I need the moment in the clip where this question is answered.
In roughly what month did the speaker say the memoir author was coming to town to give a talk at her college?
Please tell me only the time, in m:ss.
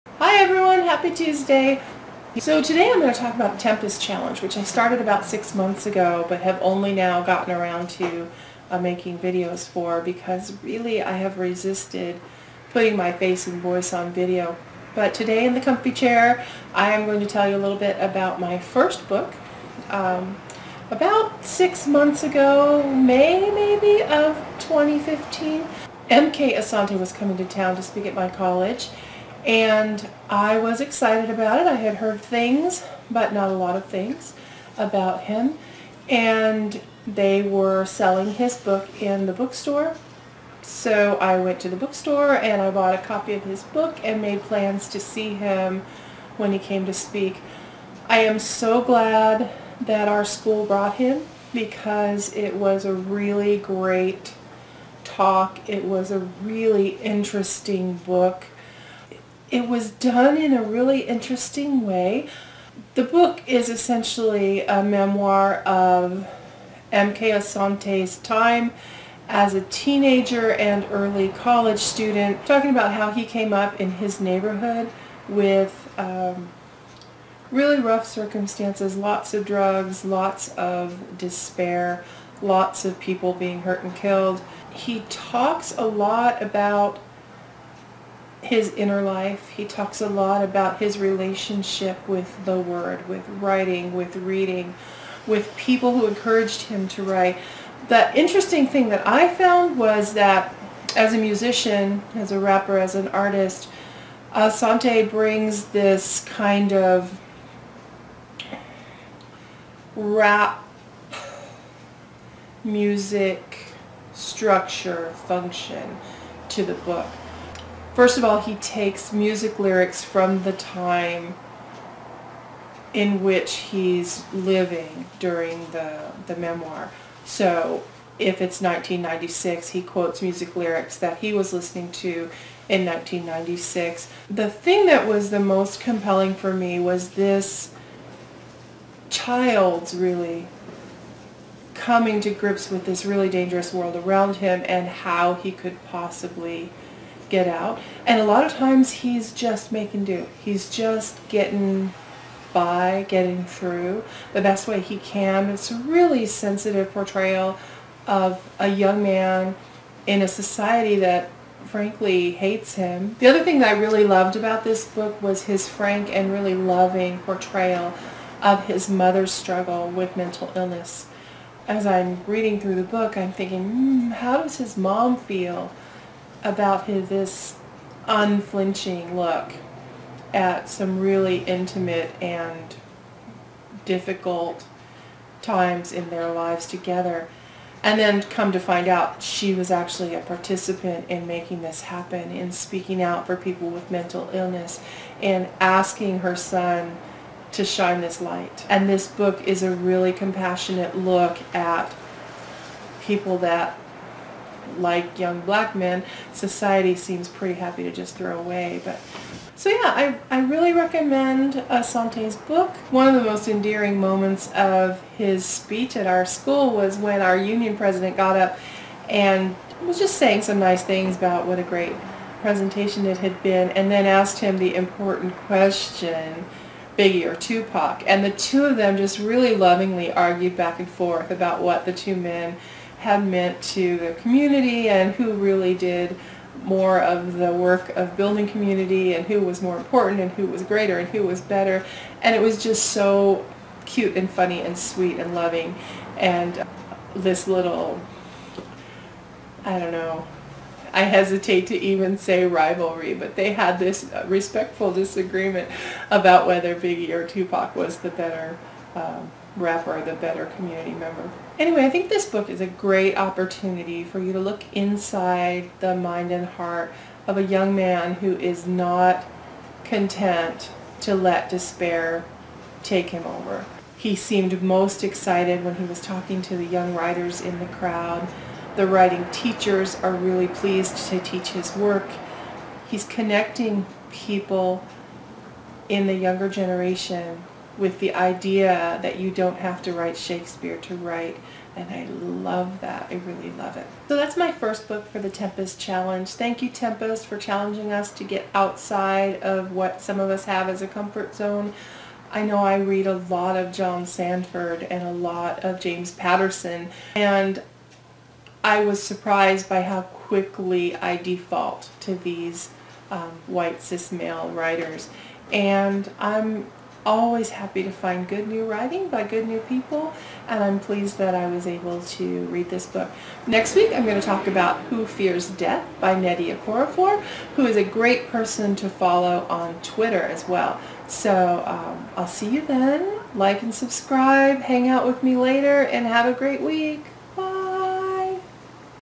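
0:22.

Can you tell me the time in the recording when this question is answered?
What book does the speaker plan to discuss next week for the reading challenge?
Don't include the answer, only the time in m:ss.
5:24.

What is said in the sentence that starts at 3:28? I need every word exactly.
But so yeah, I, I really recommend Asante's uh, book.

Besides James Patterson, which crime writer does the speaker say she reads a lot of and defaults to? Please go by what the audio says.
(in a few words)
John Sandford.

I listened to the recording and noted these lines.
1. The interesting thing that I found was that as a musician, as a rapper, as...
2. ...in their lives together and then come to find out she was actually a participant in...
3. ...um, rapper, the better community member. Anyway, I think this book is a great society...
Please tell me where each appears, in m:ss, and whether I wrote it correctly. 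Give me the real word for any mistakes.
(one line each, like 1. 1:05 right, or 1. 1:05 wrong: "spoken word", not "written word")
1. 1:37 right
2. 3:05 right
3. 4:18 wrong: "opportunity", not "society".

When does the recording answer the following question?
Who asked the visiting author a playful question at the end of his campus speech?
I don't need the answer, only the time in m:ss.
3:37.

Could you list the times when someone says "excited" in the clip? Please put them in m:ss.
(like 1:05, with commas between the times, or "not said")
0:30, 4:35.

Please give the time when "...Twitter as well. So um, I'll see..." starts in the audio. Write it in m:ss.
5:29.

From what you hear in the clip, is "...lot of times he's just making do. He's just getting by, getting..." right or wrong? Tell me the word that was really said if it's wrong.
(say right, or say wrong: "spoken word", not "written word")
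right.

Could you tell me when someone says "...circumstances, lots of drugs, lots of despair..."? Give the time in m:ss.
1:18.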